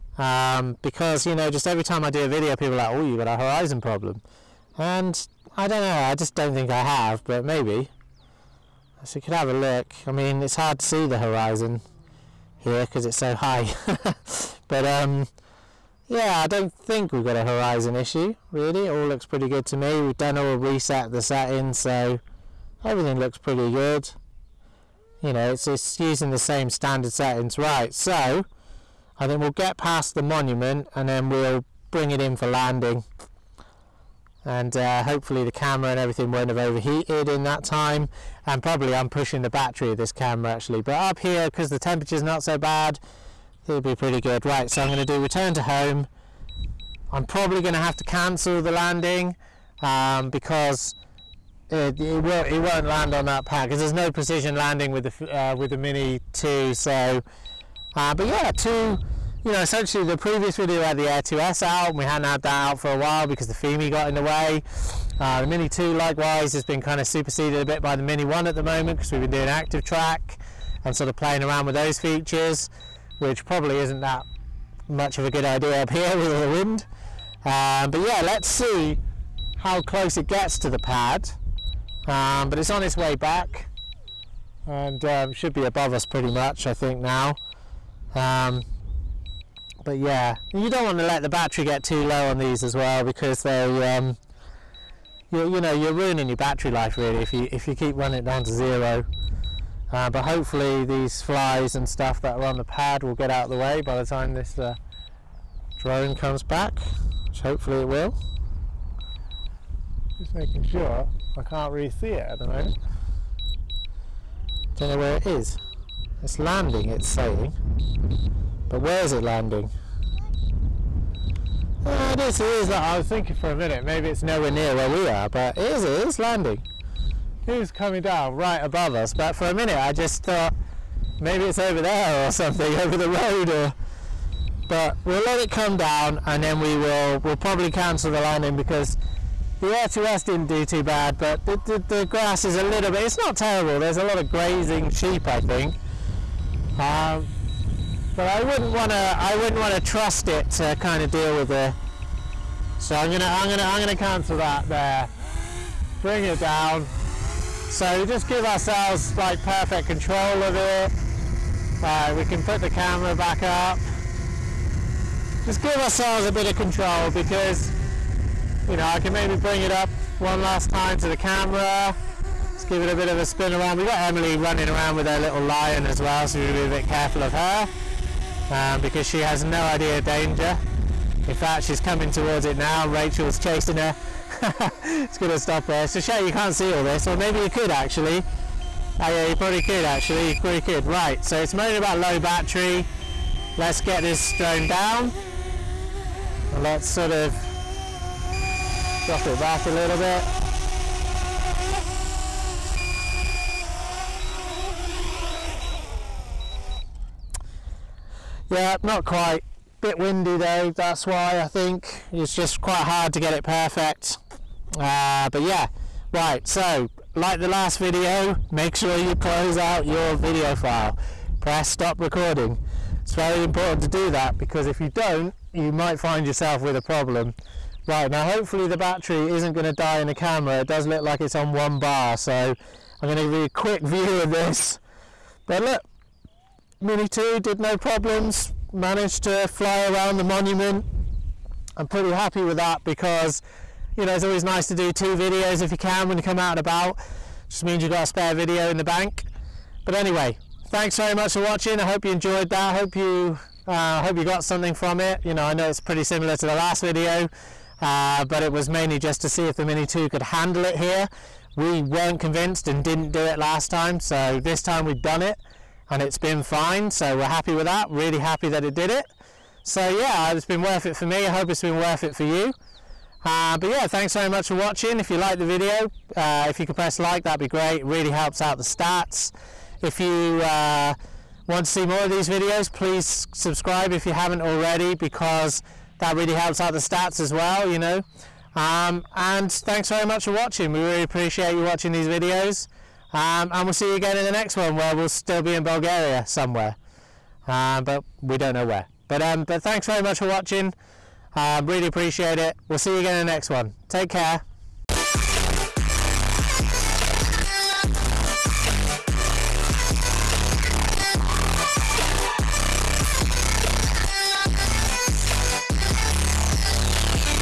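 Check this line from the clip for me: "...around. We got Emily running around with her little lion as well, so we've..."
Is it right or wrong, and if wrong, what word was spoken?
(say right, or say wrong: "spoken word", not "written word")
right.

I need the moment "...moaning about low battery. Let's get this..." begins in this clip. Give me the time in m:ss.
3:11.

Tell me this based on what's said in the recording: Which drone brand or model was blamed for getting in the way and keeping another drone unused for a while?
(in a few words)
Fimi.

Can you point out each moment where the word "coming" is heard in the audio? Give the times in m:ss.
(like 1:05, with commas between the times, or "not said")
2:07, 3:01.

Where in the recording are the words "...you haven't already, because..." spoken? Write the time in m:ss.
4:44.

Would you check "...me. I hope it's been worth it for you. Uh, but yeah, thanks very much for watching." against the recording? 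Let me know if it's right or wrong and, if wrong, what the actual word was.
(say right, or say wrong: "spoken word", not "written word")
right.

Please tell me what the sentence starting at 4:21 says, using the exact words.
We weren't convinced and didn't do it last time.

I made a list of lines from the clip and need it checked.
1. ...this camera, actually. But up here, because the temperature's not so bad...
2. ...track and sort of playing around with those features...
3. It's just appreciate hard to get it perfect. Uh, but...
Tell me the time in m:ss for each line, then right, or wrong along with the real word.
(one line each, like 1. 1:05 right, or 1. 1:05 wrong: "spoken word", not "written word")
1. 0:39 right
2. 1:09 right
3. 3:32 wrong: "quite", not "appreciate".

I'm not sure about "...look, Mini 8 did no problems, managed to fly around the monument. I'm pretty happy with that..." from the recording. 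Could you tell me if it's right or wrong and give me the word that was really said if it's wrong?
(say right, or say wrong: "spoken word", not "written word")
wrong: "2", not "8".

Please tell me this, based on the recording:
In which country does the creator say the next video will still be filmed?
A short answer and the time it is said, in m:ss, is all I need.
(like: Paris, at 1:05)
Bulgaria, at 4:55.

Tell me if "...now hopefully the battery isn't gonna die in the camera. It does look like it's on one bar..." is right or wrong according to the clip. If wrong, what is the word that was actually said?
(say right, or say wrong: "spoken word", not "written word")
right.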